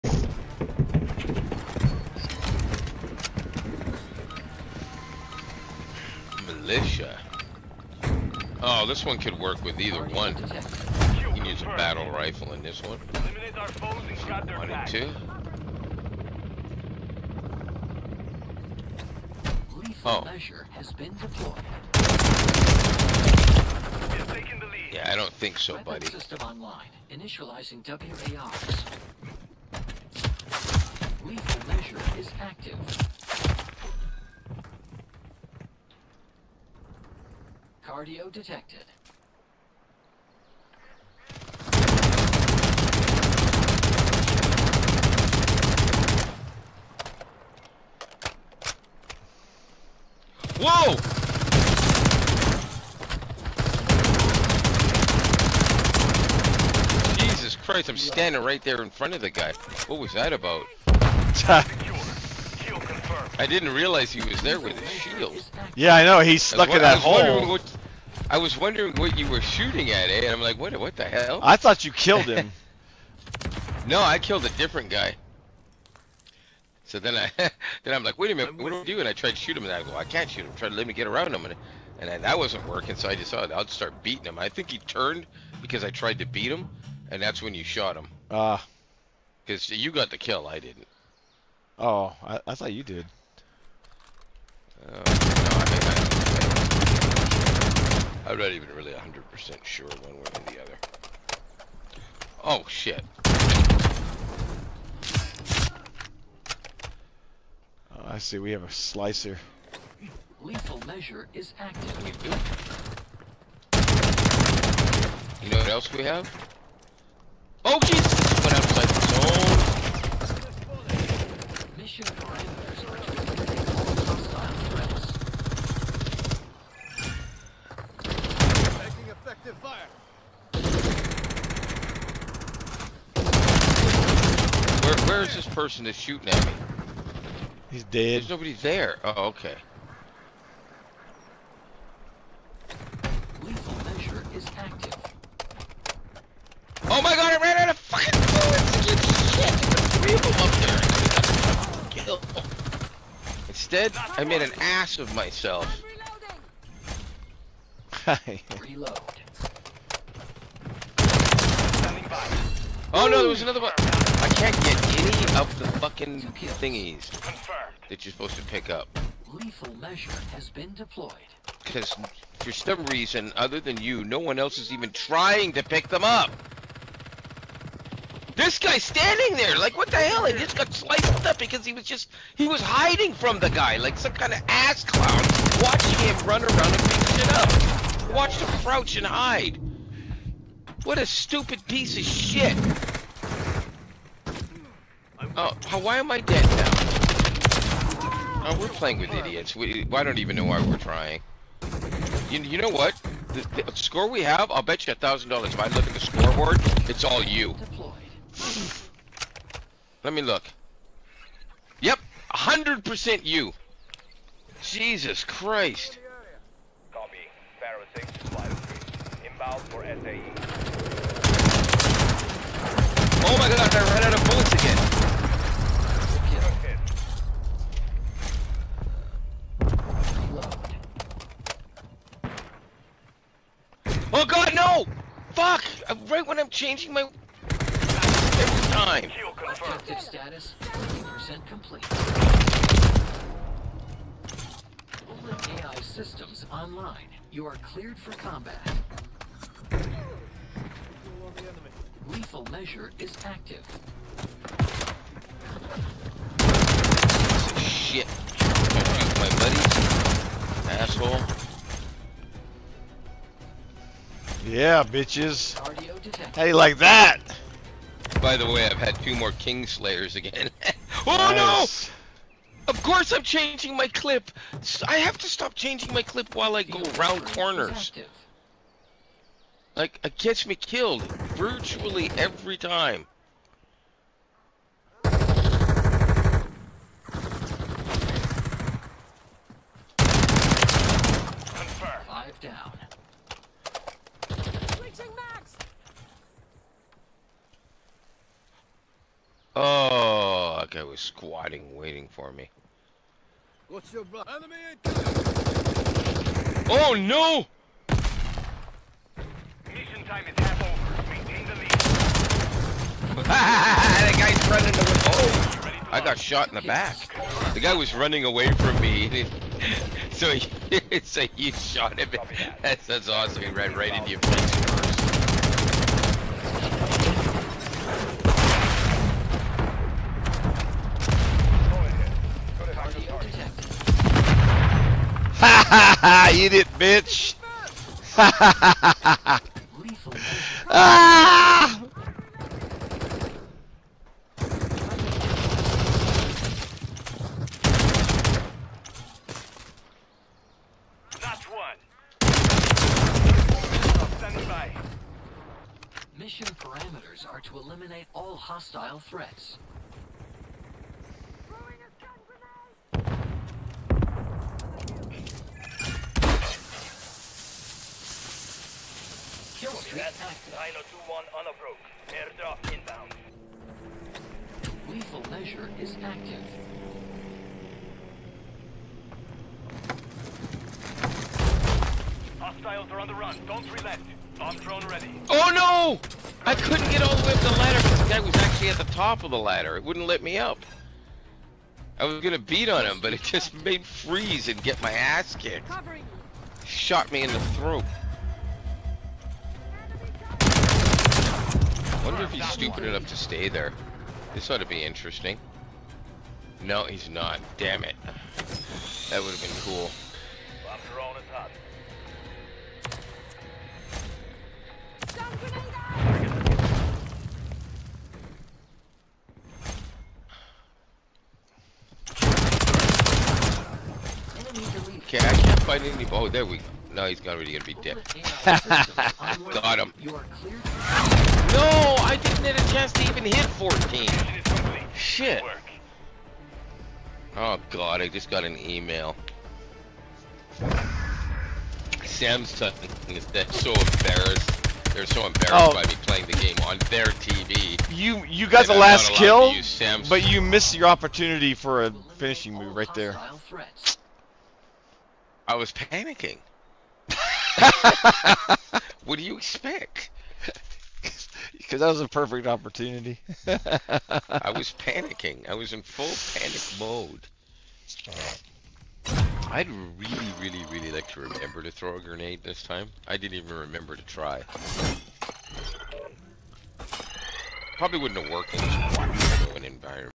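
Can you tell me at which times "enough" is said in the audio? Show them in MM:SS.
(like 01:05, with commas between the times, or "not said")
06:42.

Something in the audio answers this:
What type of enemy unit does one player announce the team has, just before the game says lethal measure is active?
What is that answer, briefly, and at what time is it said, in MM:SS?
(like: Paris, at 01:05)
Slicer, at 01:48.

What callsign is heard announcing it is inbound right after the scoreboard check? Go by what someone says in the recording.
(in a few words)
Pharaoh six.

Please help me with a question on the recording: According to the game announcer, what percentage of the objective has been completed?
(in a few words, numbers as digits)
50%.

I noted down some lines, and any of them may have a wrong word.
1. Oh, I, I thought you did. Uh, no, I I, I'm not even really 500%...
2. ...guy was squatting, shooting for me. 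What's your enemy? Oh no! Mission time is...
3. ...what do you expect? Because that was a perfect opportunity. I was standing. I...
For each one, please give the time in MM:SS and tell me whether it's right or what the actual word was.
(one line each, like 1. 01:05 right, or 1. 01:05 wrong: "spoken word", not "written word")
1. 01:31 wrong: "100", not "500"
2. 05:00 wrong: "waiting", not "shooting"
3. 07:39 wrong: "panicking", not "standing".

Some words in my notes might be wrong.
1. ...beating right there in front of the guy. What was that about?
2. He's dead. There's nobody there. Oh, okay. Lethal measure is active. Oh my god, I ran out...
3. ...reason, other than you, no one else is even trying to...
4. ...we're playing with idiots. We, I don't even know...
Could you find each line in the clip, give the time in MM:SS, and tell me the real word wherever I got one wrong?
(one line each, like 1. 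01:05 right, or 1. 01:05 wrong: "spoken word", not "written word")
1. 00:57 wrong: "standing", not "beating"
2. 02:17 right
3. 02:52 right
4. 03:18 right.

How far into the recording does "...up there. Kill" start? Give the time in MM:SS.
02:31.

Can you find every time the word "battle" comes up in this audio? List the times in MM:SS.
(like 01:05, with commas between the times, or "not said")
00:11.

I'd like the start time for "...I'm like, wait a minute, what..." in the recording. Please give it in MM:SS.
01:17.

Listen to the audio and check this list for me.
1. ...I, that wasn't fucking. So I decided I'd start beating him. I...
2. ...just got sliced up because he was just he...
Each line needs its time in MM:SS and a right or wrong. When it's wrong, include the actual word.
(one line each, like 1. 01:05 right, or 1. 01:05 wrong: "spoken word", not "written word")
1. 01:22 wrong: "working", not "fucking"
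2. 03:00 right.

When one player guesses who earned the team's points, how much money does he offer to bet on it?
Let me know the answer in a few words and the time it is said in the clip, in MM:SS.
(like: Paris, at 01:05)
$1,000, at 03:24.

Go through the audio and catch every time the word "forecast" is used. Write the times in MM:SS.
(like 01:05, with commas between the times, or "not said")
not said.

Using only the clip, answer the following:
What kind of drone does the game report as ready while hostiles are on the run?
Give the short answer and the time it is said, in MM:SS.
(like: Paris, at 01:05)
Bomb drone, at 06:24.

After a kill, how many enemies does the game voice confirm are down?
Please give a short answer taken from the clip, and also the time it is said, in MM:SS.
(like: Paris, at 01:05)
5, at 04:52.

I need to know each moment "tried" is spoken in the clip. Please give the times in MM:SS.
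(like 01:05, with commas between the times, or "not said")
01:19, 01:25.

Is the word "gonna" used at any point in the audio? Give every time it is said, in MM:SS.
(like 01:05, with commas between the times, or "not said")
06:32, 07:07.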